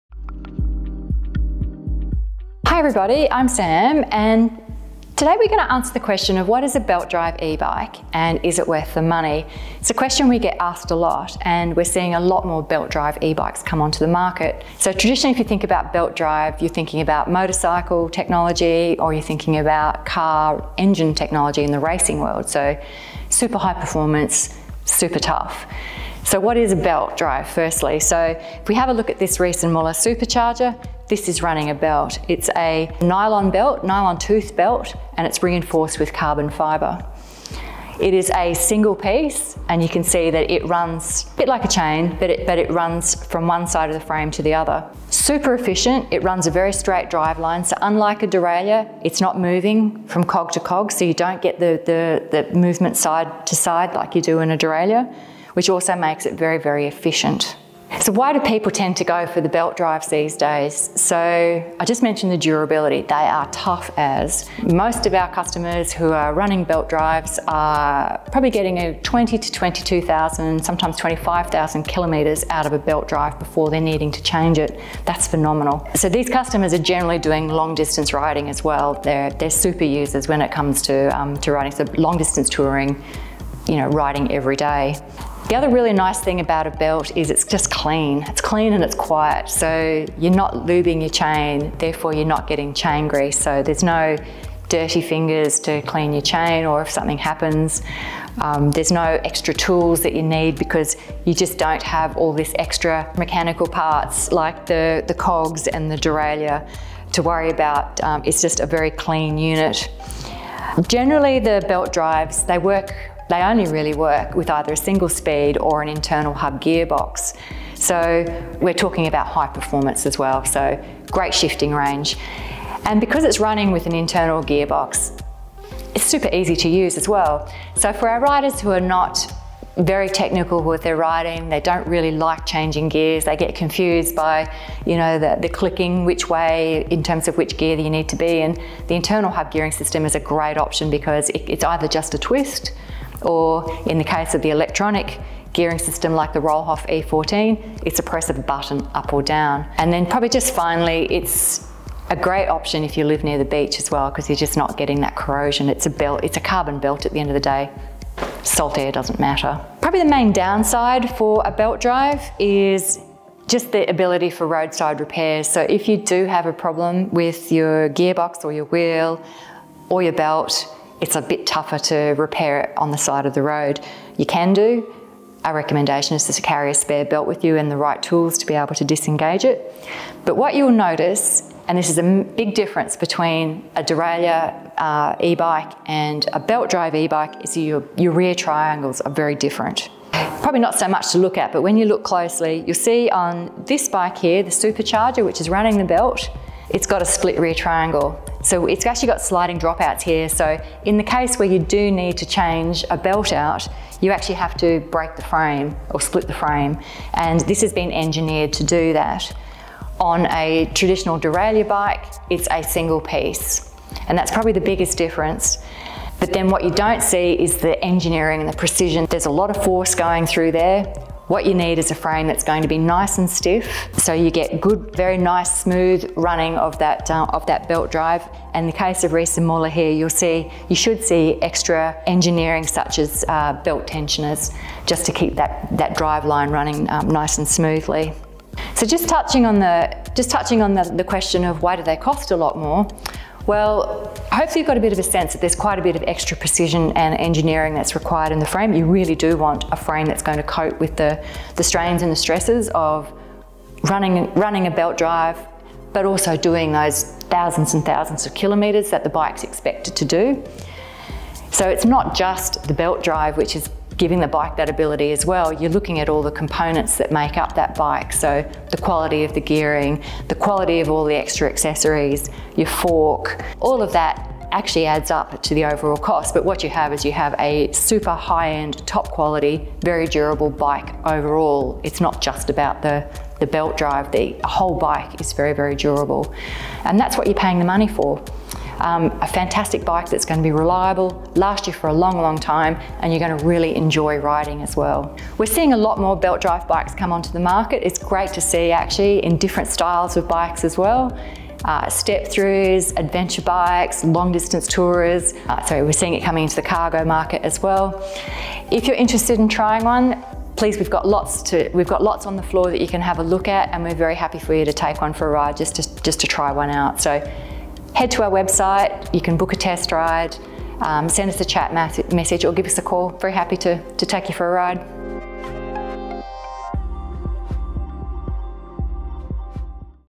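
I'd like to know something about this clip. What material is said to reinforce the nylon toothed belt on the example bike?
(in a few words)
carbon fiber.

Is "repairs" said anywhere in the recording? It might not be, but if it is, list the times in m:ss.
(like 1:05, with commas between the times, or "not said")
2:44, 2:52.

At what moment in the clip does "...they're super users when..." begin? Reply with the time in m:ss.
1:19.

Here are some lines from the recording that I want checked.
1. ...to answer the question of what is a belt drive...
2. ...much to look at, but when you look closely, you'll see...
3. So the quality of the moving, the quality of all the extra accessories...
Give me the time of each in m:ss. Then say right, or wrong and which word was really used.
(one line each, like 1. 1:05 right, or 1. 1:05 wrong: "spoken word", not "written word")
1. 0:05 right
2. 3:10 right
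3. 4:28 wrong: "gearing", not "moving".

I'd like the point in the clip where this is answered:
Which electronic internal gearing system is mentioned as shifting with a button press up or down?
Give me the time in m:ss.
2:26.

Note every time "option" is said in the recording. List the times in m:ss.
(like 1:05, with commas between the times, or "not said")
2:20, 2:32.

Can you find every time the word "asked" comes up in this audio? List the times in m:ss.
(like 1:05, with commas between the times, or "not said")
0:10.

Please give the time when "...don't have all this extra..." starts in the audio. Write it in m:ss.
1:41.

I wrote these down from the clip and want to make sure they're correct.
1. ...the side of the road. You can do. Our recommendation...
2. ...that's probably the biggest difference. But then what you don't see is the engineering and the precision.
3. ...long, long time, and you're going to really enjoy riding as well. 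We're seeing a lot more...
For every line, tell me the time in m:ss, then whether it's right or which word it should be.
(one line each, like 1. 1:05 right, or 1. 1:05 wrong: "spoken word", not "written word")
1. 2:52 right
2. 3:34 right
3. 4:51 right.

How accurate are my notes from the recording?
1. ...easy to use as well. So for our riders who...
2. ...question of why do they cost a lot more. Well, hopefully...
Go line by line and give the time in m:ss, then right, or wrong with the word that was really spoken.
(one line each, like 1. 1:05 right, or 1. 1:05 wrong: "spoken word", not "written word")
1. 2:06 right
2. 4:01 right.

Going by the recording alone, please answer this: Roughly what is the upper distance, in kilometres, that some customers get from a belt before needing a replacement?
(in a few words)
25,000.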